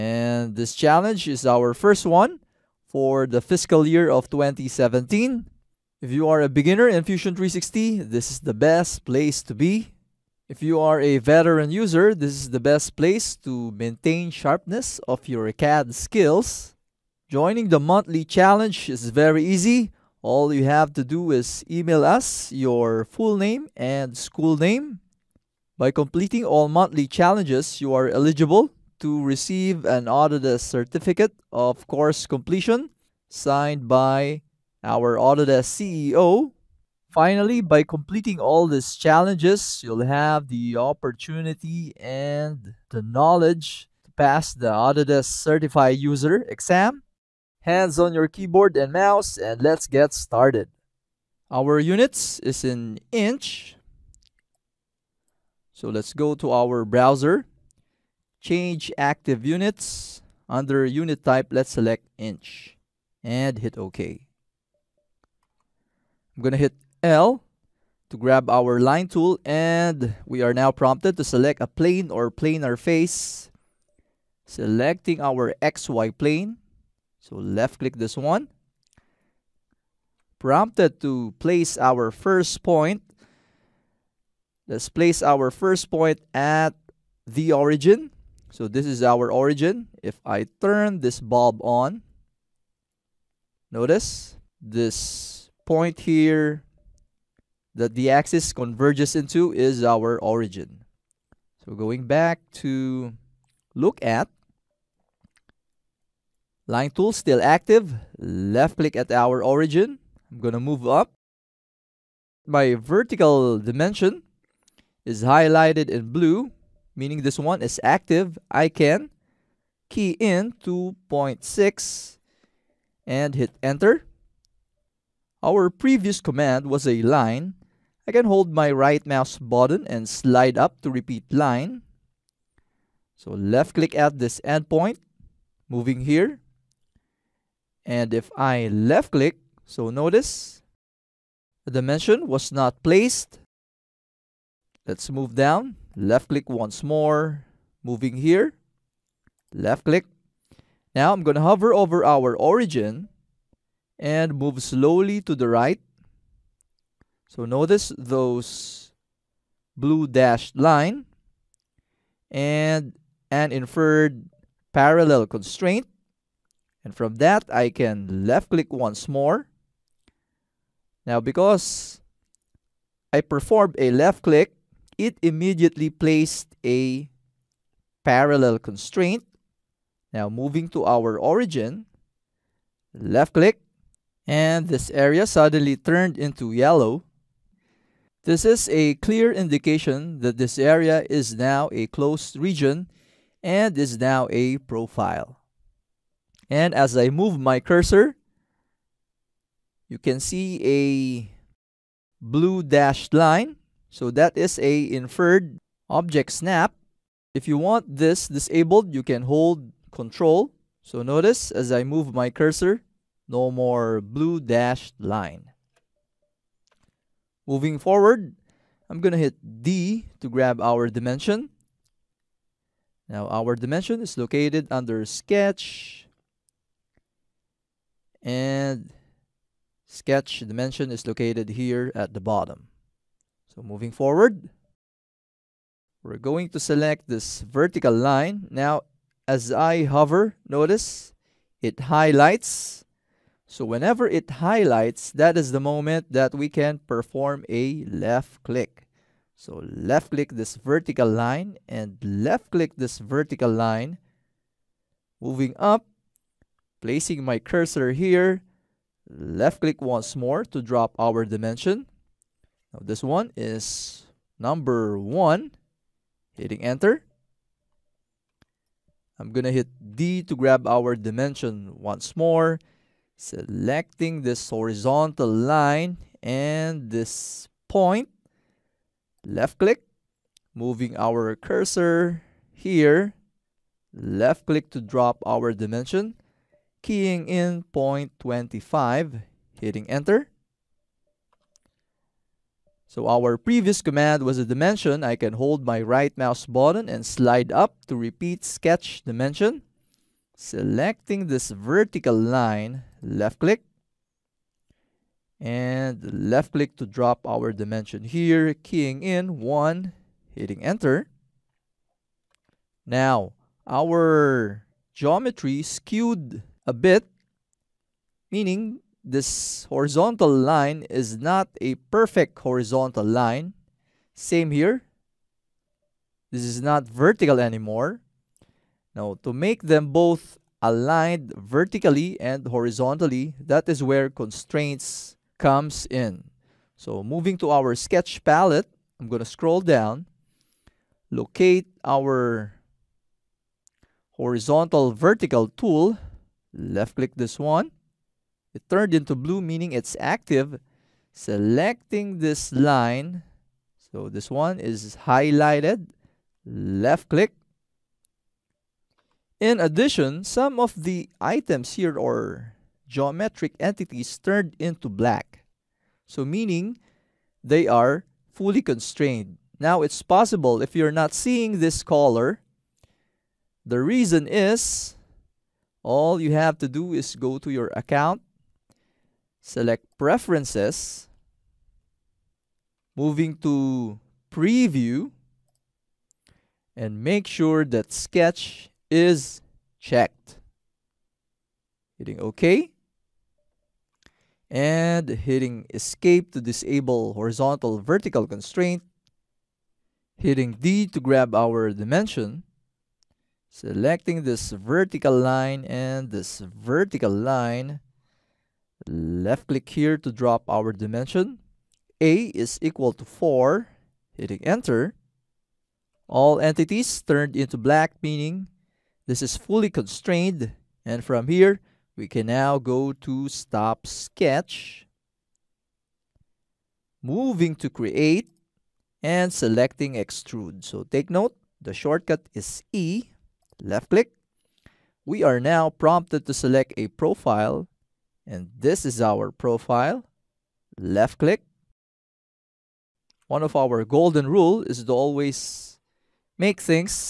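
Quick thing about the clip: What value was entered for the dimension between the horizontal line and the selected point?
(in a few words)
0.25.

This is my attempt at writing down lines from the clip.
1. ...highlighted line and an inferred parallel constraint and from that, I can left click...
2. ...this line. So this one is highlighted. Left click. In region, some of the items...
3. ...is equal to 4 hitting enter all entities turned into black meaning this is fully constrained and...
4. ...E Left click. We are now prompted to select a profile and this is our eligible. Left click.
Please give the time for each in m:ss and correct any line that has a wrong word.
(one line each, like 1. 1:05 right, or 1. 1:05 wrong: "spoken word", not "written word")
1. 2:40 wrong: "dashed", not "highlighted"
2. 5:52 wrong: "addition", not "region"
3. 6:52 right
4. 7:12 wrong: "profile", not "eligible".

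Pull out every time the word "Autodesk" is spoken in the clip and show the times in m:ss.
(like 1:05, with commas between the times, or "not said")
0:30, 0:35, 0:44.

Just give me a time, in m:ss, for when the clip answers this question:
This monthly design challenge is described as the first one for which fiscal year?
0:04.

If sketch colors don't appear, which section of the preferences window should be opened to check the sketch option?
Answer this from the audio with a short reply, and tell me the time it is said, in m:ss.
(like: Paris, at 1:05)
preview, at 6:24.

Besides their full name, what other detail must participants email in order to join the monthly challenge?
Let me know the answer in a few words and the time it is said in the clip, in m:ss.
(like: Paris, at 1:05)
school name, at 0:24.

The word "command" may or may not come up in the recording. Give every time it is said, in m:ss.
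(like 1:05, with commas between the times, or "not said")
2:06, 4:53.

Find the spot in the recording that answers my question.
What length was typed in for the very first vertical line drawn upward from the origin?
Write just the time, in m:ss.
2:00.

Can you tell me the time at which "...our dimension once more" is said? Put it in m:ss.
4:30.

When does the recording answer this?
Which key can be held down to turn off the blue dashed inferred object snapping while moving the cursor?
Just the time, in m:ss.
3:29.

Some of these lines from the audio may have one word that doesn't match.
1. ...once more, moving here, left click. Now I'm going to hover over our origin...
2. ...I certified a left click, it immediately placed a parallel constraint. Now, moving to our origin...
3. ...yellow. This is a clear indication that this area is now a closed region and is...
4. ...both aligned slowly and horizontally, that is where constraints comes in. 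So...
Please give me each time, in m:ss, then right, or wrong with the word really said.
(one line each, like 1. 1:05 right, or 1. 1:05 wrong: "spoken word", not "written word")
1. 2:26 right
2. 2:53 wrong: "performed", not "certified"
3. 3:06 right
4. 5:29 wrong: "vertically", not "slowly".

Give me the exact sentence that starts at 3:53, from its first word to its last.
So moving forward, we're going to select this vertical line.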